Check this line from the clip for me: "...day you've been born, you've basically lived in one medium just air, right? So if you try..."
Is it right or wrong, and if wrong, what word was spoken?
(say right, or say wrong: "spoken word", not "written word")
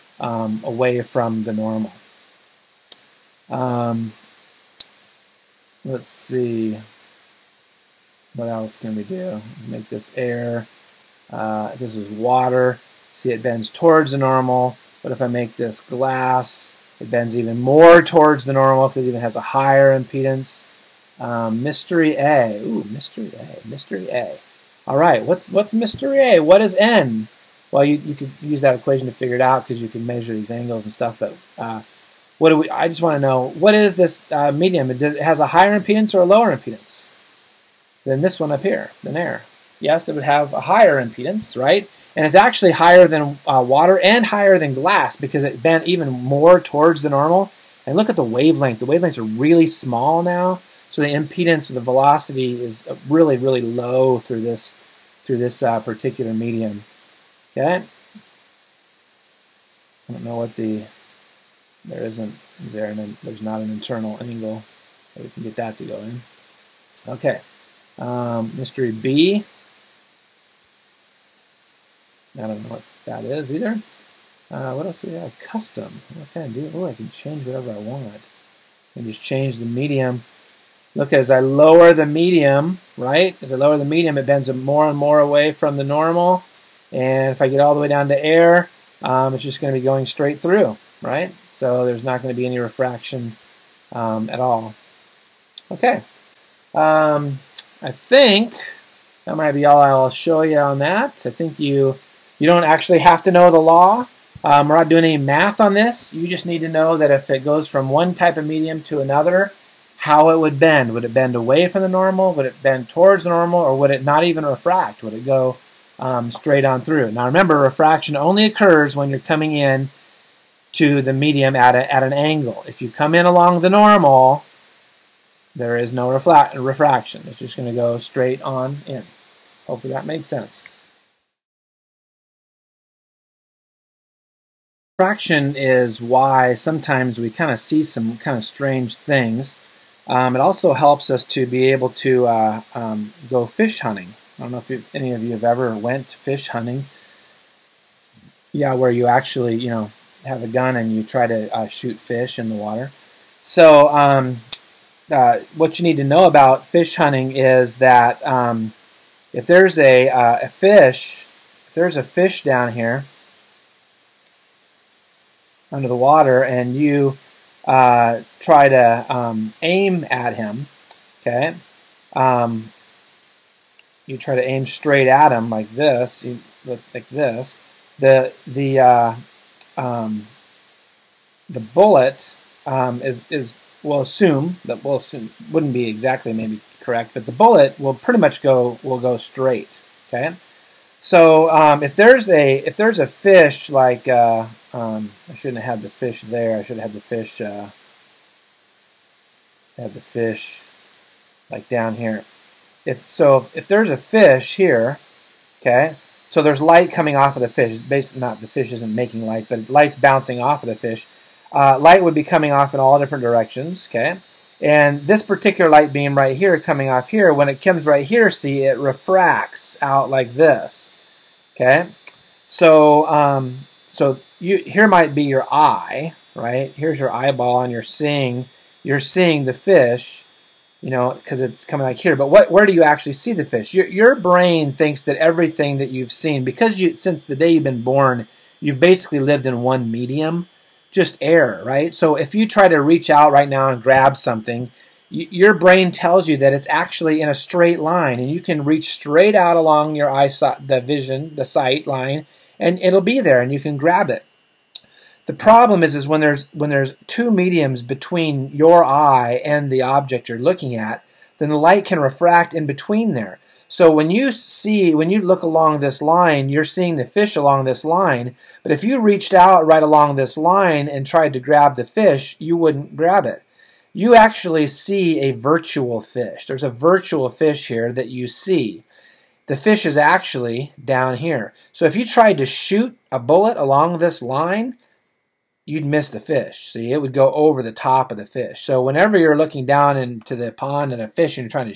right.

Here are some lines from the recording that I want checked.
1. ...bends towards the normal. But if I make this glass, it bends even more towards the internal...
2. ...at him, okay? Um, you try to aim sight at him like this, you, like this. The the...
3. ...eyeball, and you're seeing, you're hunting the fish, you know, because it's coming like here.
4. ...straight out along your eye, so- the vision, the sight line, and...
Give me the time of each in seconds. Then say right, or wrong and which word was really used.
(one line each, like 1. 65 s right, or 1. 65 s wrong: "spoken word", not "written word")
1. 13 s wrong: "normal", not "internal"
2. 170 s wrong: "straight", not "sight"
3. 227 s wrong: "seeing", not "hunting"
4. 248 s right.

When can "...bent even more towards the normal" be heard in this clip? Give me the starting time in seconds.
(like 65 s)
45 s.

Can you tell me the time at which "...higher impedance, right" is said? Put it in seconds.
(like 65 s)
40 s.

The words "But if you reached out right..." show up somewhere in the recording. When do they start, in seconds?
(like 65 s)
268 s.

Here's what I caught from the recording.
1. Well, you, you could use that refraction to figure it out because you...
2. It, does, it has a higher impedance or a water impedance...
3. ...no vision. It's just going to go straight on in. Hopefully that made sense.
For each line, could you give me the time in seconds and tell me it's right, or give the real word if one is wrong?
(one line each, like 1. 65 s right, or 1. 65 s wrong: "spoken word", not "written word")
1. 27 s wrong: "equation", not "refraction"
2. 34 s wrong: "lower", not "water"
3. 125 s wrong: "refraction", not "vision".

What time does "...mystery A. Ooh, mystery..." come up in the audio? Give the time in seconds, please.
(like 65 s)
21 s.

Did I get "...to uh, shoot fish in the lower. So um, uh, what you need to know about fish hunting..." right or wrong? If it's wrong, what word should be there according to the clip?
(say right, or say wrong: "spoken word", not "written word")
wrong: "water", not "lower".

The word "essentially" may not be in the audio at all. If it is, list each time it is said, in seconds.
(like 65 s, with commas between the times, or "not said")
not said.